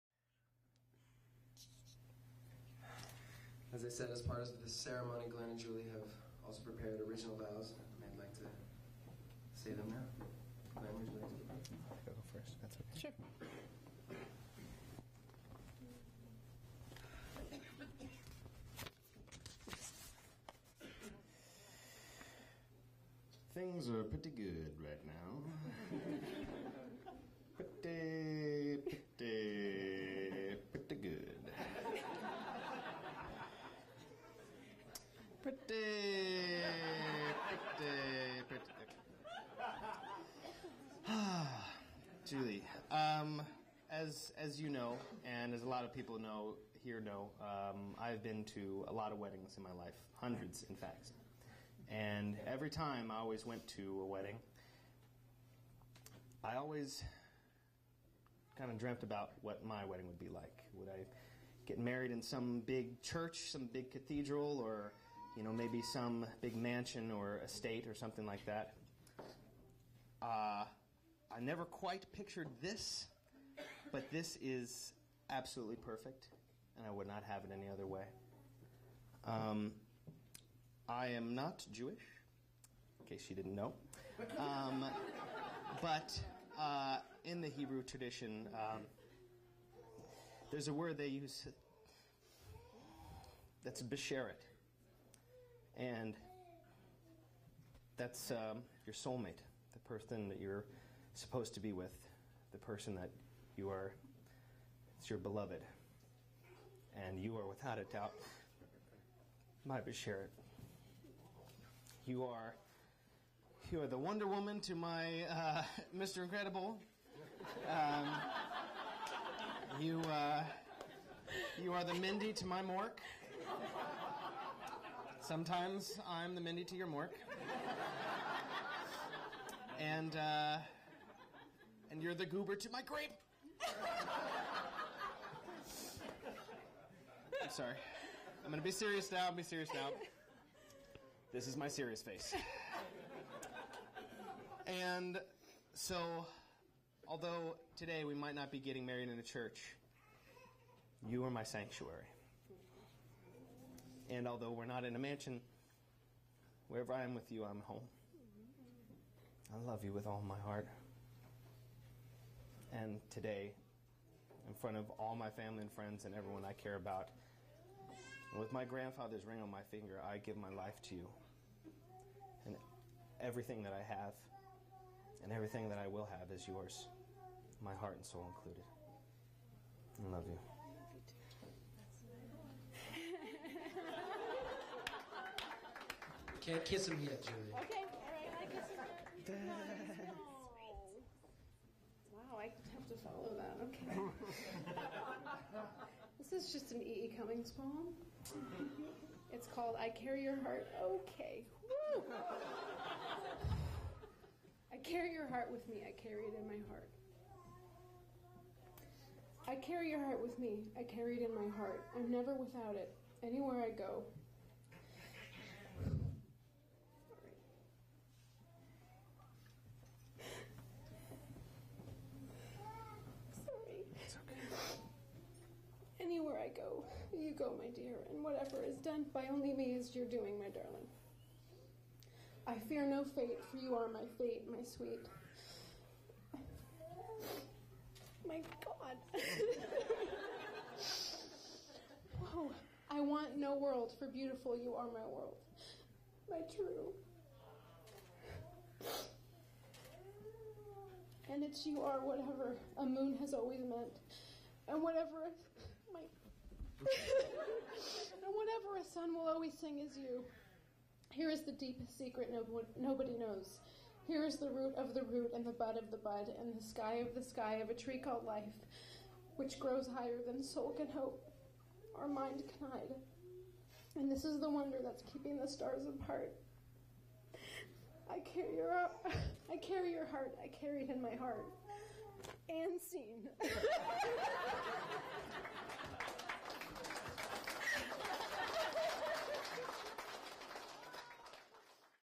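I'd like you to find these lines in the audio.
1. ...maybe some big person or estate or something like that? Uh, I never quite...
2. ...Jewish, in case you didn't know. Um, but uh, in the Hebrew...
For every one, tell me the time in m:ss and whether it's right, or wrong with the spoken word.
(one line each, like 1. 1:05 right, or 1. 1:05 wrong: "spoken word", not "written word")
1. 1:05 wrong: "mansion", not "person"
2. 1:21 right.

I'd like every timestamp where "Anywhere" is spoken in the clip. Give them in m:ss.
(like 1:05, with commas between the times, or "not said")
3:33.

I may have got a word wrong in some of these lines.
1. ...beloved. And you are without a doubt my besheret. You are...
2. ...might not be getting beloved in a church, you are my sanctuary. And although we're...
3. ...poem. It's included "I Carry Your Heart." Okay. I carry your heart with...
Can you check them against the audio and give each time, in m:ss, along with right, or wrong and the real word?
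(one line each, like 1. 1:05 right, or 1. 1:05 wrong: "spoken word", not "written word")
1. 1:45 right
2. 2:28 wrong: "married", not "beloved"
3. 3:17 wrong: "called", not "included".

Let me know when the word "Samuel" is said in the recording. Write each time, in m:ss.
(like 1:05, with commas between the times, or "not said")
not said.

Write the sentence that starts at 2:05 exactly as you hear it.
Sometimes I'm the Mindy to your Mork.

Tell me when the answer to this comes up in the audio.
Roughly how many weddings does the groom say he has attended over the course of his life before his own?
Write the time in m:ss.
0:50.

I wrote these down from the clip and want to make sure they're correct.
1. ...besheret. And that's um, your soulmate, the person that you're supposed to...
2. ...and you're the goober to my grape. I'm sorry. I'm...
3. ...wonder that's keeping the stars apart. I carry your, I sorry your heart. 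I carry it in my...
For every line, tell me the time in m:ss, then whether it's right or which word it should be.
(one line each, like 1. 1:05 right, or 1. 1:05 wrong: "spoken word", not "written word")
1. 1:33 right
2. 2:11 right
3. 4:34 wrong: "carry", not "sorry".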